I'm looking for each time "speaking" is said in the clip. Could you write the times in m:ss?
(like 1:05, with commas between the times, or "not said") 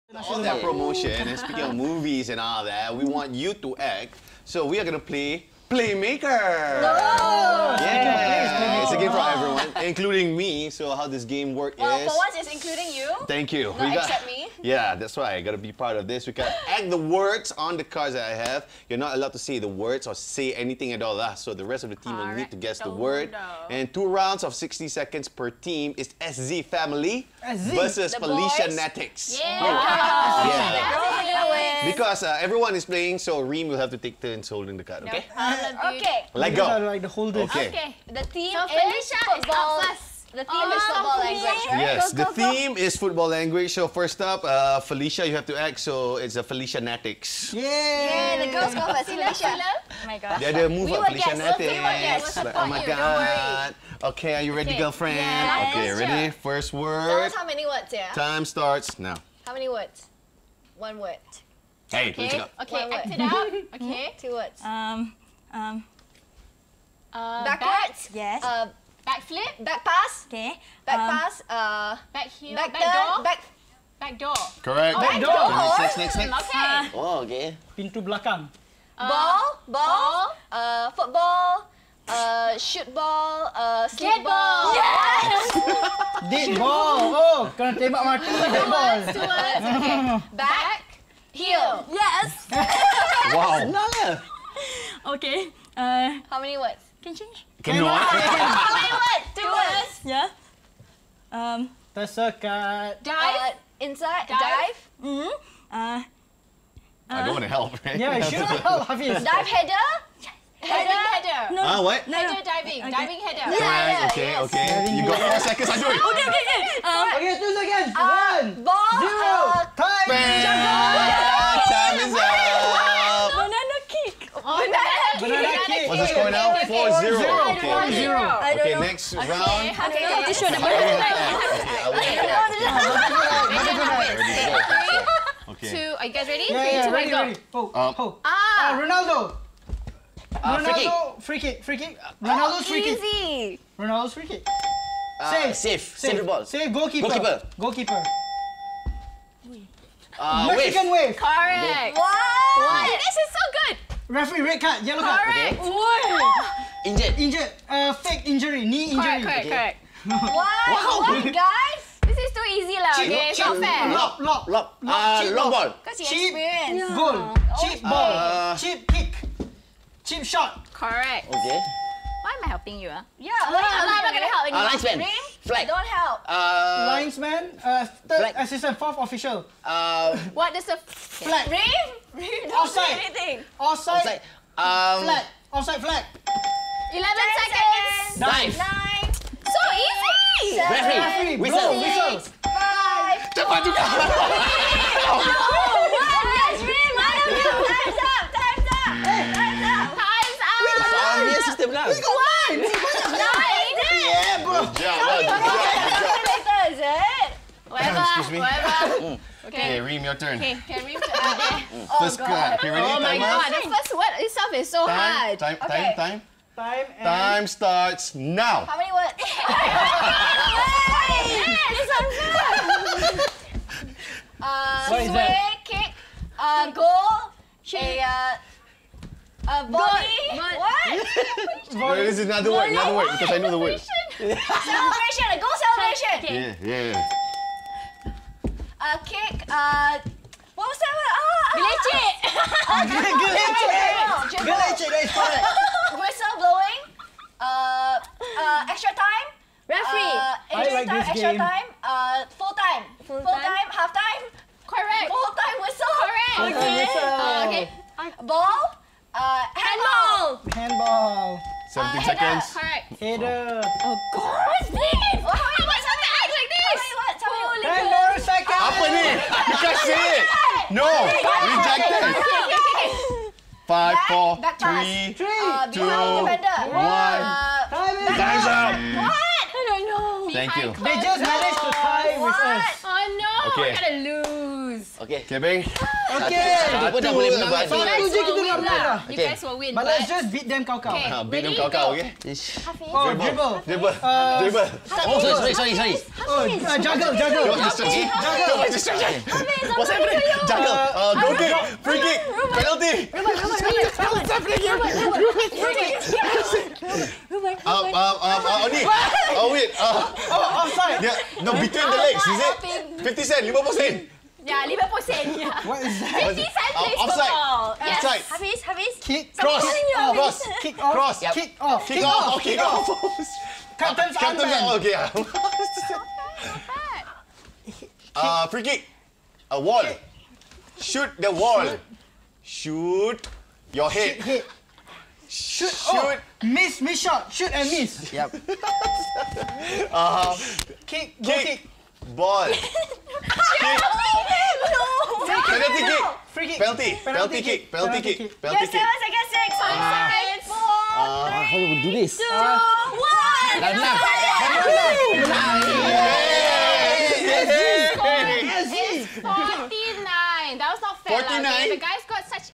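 0:01.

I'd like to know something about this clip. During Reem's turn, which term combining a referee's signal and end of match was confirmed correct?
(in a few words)
Full time whistle.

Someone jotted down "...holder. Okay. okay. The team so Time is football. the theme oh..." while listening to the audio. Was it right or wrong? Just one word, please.
wrong.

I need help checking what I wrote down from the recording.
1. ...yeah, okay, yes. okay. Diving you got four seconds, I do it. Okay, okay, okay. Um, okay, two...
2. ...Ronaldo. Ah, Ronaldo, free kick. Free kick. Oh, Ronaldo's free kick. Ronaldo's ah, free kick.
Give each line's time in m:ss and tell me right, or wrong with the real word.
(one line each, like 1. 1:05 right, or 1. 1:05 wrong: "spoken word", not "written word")
1. 1:53 right
2. 2:18 right.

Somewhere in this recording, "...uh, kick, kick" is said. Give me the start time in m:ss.
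5:39.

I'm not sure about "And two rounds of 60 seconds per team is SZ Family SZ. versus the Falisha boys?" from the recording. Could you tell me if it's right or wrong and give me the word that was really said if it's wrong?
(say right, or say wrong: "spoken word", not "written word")
right.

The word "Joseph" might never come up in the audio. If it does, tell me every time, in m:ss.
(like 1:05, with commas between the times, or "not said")
not said.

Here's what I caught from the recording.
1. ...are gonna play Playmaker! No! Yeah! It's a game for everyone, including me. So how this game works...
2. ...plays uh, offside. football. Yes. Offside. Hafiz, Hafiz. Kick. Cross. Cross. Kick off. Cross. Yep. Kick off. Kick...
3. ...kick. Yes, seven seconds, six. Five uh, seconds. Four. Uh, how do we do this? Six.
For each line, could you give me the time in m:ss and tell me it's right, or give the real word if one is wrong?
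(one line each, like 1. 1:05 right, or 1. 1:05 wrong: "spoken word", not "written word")
1. 0:04 right
2. 5:16 right
3. 5:48 wrong: "Two", not "Six".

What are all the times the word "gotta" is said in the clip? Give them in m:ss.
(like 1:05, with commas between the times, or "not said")
0:15, 4:43.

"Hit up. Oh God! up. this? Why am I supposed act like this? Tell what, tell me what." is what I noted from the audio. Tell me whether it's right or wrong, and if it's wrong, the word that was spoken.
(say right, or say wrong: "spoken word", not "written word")
right.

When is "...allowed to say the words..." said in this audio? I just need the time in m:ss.
0:19.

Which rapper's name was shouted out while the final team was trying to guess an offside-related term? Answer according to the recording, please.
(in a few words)
50 Cent.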